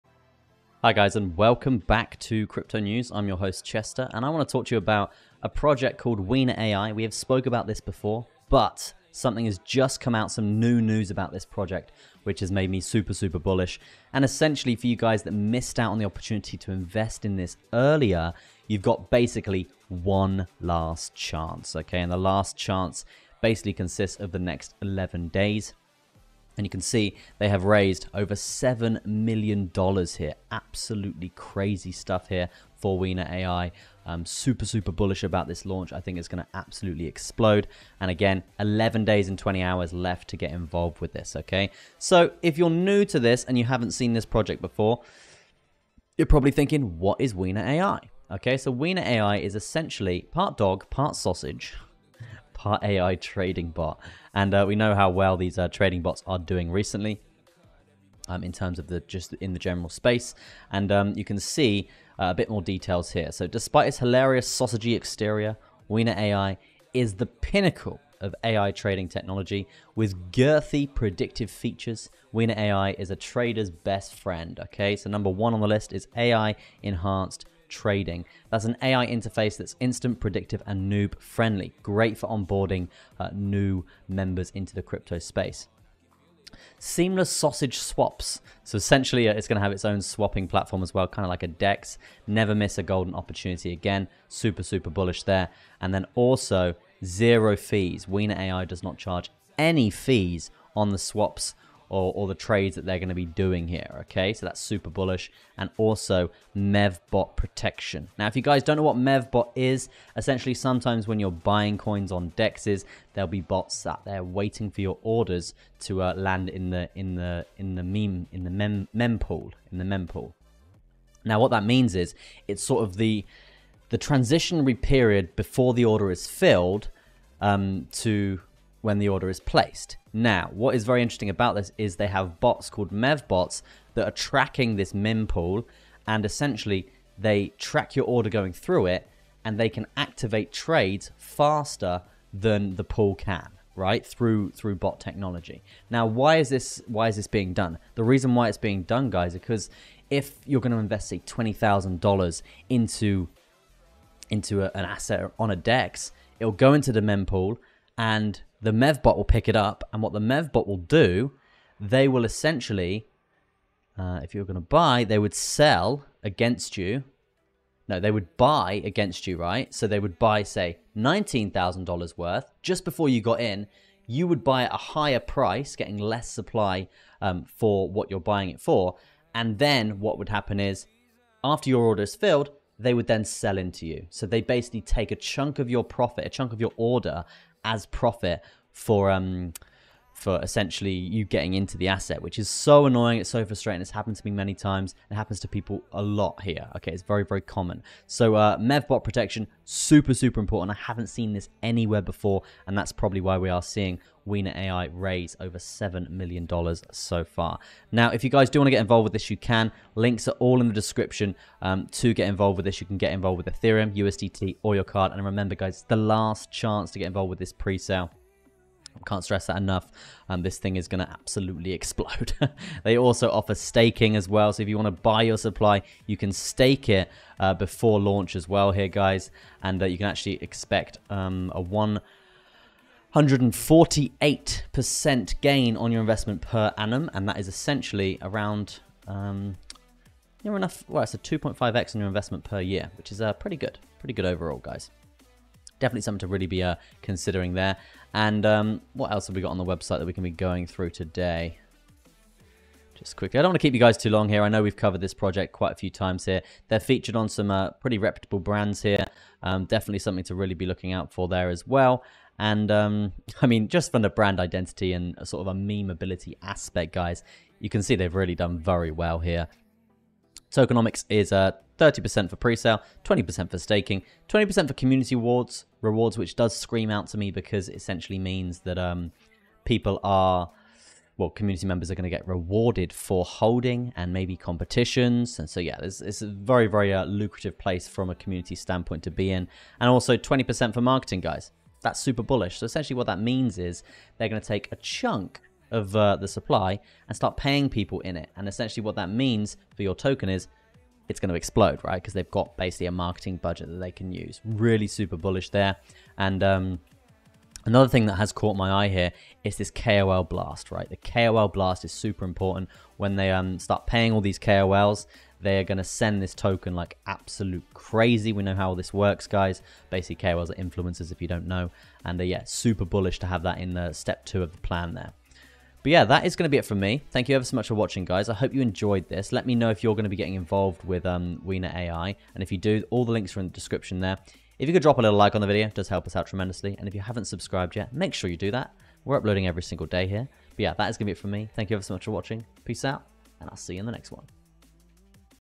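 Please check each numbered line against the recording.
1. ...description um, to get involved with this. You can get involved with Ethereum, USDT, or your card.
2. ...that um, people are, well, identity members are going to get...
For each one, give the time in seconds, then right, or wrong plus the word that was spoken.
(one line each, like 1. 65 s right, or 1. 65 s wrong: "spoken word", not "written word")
1. 210 s right
2. 278 s wrong: "community", not "identity".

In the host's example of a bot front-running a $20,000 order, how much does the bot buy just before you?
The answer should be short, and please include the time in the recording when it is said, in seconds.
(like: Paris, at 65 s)
$19,000, at 170 s.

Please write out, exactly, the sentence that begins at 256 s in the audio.
They're featured on some uh, pretty reputable brands here.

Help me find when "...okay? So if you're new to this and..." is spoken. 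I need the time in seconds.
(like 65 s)
41 s.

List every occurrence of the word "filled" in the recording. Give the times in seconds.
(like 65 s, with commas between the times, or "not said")
126 s, 182 s.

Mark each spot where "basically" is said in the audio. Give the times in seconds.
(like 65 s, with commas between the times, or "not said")
19 s, 23 s, 184 s, 302 s, 319 s.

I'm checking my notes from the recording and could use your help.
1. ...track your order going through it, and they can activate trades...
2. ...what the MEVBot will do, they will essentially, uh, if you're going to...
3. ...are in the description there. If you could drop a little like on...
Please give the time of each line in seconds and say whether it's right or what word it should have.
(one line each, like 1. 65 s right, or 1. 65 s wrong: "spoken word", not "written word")
1. 137 s right
2. 160 s right
3. 333 s right.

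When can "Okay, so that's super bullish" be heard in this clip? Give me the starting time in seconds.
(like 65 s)
104 s.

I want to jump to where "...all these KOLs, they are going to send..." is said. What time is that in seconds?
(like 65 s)
314 s.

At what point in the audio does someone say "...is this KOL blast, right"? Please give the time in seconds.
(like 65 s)
309 s.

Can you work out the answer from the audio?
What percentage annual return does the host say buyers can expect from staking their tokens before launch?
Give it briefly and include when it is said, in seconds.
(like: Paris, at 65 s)
148%, at 233 s.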